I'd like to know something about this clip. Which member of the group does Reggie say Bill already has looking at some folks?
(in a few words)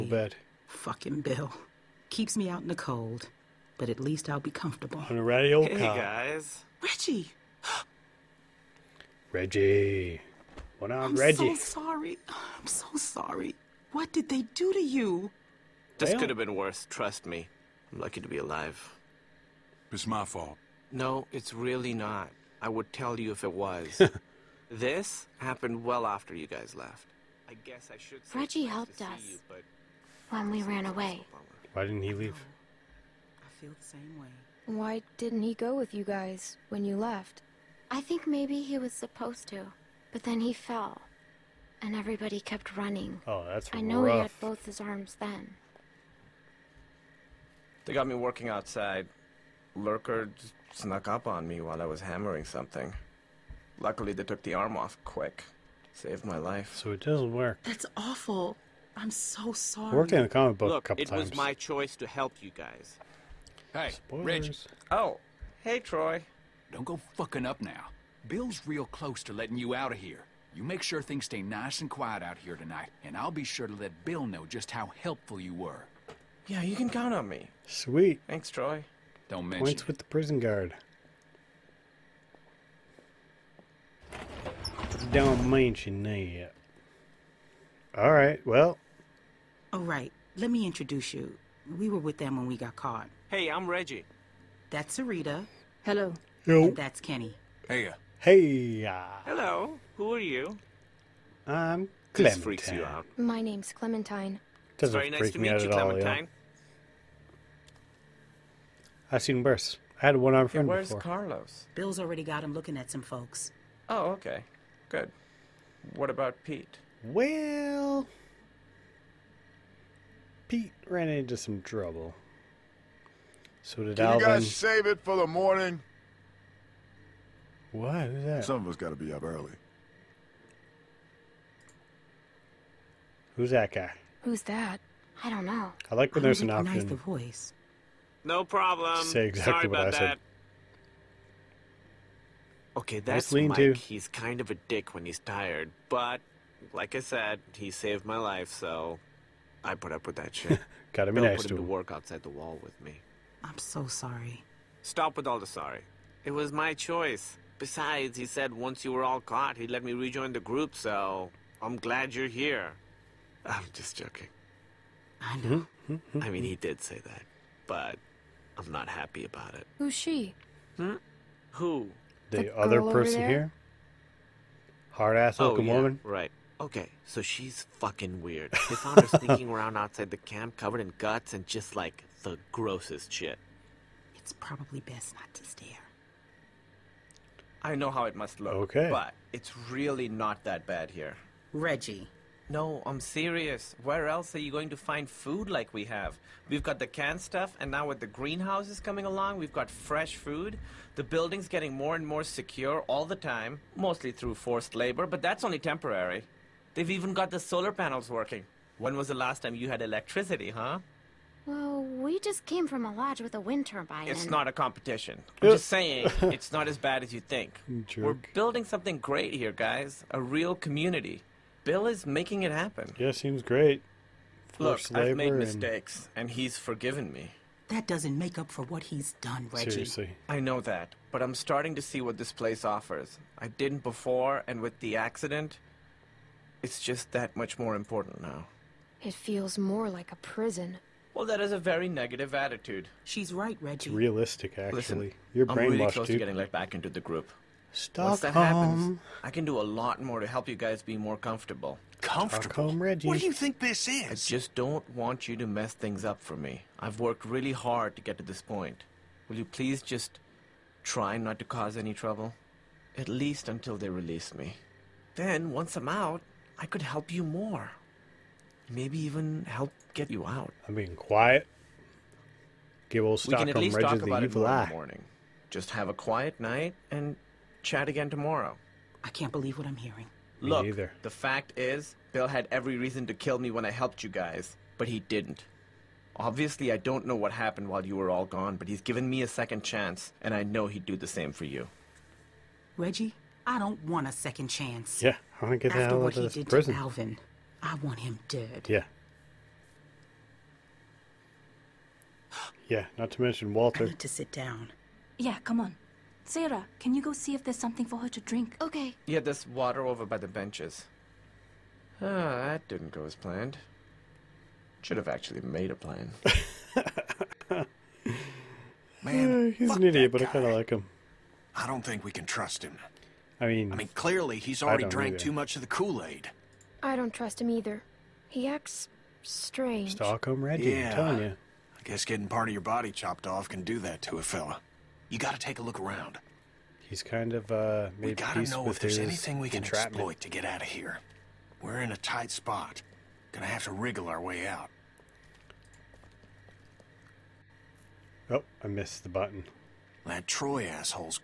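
Carlos.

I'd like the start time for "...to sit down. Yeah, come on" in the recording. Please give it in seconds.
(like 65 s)
303 s.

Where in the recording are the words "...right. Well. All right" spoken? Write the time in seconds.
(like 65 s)
88 s.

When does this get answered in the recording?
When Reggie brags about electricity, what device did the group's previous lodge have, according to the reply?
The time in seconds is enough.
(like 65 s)
213 s.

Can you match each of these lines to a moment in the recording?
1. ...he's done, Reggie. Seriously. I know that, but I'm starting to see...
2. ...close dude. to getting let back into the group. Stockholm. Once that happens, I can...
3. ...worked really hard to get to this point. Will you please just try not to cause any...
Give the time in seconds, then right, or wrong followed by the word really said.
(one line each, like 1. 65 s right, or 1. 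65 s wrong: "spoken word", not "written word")
1. 228 s right
2. 245 s right
3. 256 s right.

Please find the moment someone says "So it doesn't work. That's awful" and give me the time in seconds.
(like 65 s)
56 s.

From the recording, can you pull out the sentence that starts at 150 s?
Gotta be Bill nice put him to work outside the wall with me.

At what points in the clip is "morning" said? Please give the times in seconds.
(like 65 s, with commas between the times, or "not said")
125 s, 274 s.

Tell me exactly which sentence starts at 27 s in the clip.
I guess I should Reggie helped us you, when we ran away.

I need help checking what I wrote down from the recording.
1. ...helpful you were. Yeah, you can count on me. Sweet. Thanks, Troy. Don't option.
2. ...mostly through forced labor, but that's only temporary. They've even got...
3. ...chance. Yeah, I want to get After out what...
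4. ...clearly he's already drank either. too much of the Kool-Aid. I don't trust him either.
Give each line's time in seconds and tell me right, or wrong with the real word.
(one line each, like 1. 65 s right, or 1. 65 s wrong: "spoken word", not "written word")
1. 75 s wrong: "mention", not "option"
2. 203 s right
3. 294 s right
4. 323 s right.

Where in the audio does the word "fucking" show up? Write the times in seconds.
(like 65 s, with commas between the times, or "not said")
0 s, 67 s, 177 s.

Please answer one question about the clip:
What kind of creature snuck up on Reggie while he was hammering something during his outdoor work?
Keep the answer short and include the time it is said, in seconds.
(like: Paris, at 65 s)
Lurker, at 49 s.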